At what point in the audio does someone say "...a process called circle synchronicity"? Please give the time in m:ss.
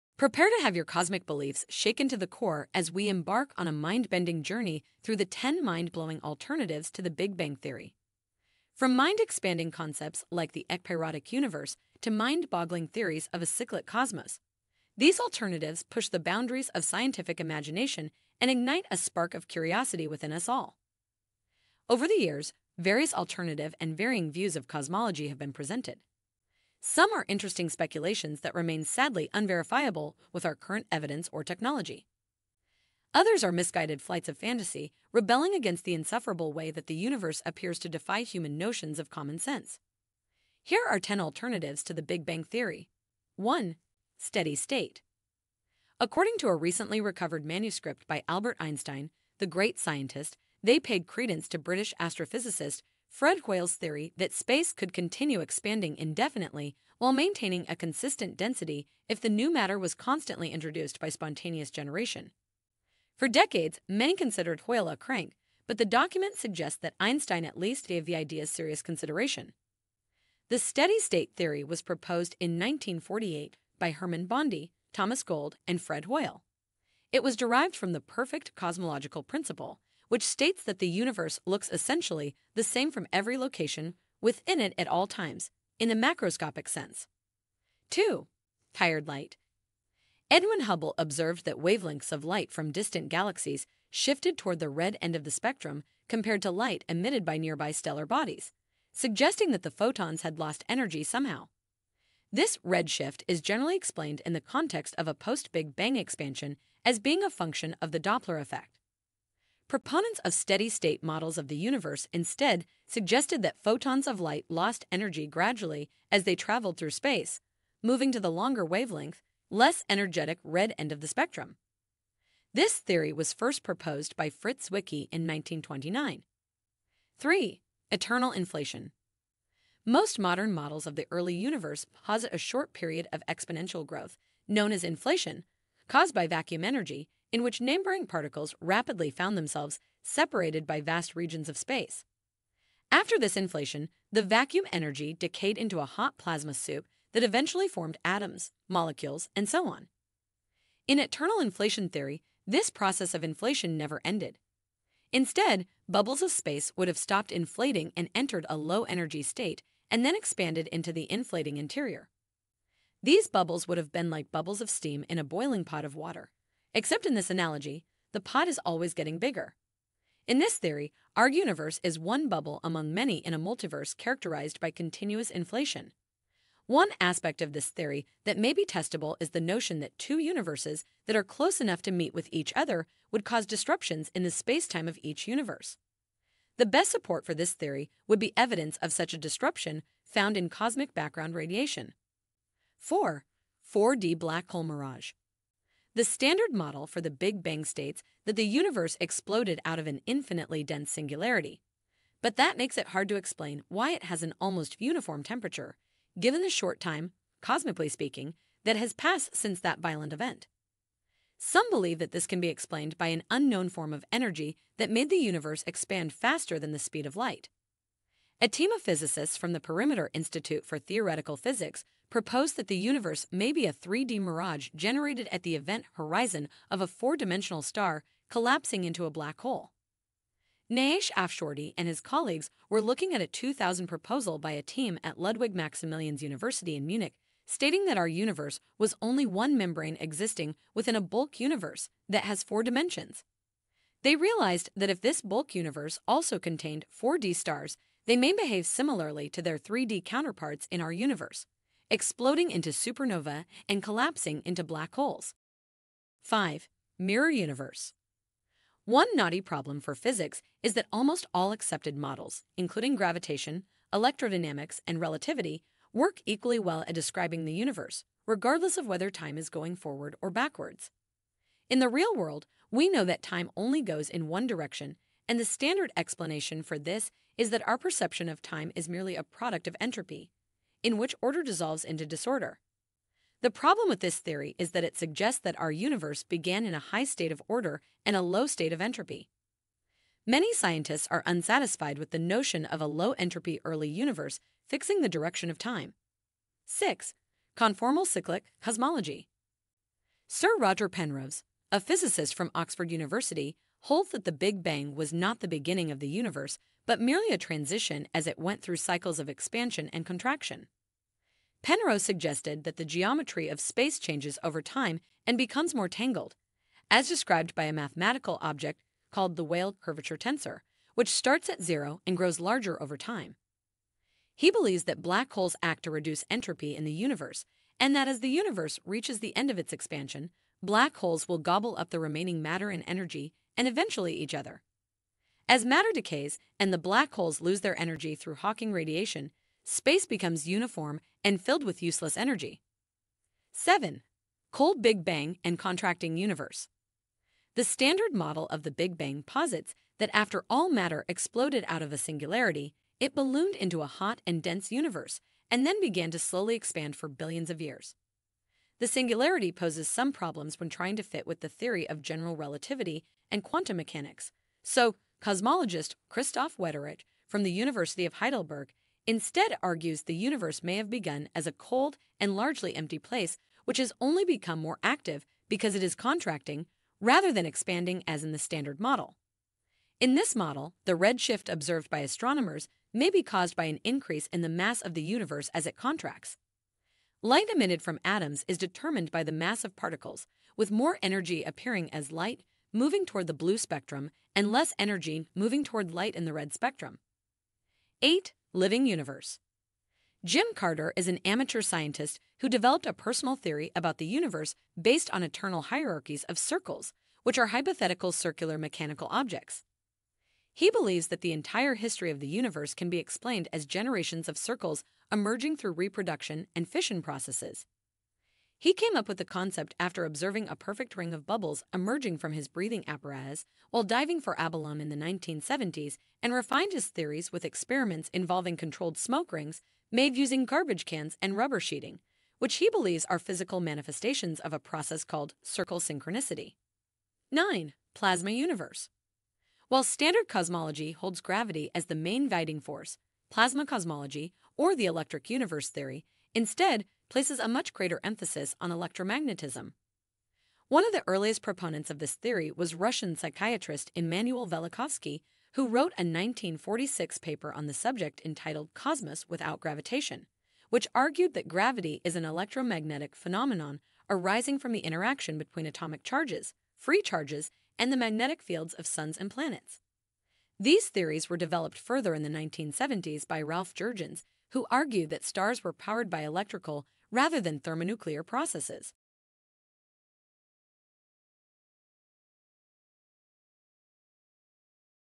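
7:14.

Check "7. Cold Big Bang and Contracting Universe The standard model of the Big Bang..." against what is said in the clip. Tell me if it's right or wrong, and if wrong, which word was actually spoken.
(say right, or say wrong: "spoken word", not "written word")
right.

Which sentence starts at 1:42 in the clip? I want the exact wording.
This redshift is generally explained in the context of a post Big Bang expansion as being a function of the Doppler effect.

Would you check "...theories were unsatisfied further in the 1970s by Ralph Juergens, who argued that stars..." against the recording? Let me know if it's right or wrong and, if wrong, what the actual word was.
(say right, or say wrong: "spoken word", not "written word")
wrong: "developed", not "unsatisfied".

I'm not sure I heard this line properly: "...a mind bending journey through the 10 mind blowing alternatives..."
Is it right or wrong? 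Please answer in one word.
right.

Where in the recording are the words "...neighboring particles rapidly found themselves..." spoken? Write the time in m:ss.
2:17.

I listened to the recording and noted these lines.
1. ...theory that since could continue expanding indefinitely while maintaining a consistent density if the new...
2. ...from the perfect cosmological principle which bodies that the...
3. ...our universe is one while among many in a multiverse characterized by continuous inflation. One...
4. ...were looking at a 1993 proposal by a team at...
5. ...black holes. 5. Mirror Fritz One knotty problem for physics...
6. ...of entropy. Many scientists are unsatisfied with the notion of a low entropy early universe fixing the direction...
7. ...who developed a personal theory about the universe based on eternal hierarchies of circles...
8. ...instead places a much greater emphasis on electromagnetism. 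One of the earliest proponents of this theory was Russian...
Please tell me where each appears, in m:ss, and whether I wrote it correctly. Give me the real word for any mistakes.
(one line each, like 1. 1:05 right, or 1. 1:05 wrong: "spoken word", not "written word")
1. 0:53 wrong: "space", not "since"
2. 1:17 wrong: "states", not "bodies"
3. 2:51 wrong: "bubble", not "while"
4. 3:52 wrong: "2000", not "1993"
5. 4:14 wrong: "Universe", not "Fritz"
6. 4:48 right
7. 6:42 right
8. 7:26 right.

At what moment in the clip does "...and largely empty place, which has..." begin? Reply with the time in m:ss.
6:12.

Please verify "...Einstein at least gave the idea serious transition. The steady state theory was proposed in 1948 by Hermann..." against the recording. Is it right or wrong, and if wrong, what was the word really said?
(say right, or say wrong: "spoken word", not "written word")
wrong: "consideration", not "transition".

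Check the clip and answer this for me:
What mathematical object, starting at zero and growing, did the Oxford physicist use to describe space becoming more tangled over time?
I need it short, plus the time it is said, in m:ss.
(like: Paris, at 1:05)
Weyl curvature tensor, at 5:19.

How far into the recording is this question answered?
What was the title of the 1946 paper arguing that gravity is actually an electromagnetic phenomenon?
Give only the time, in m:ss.
7:38.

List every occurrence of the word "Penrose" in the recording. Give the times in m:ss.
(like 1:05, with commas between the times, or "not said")
5:00, 5:11.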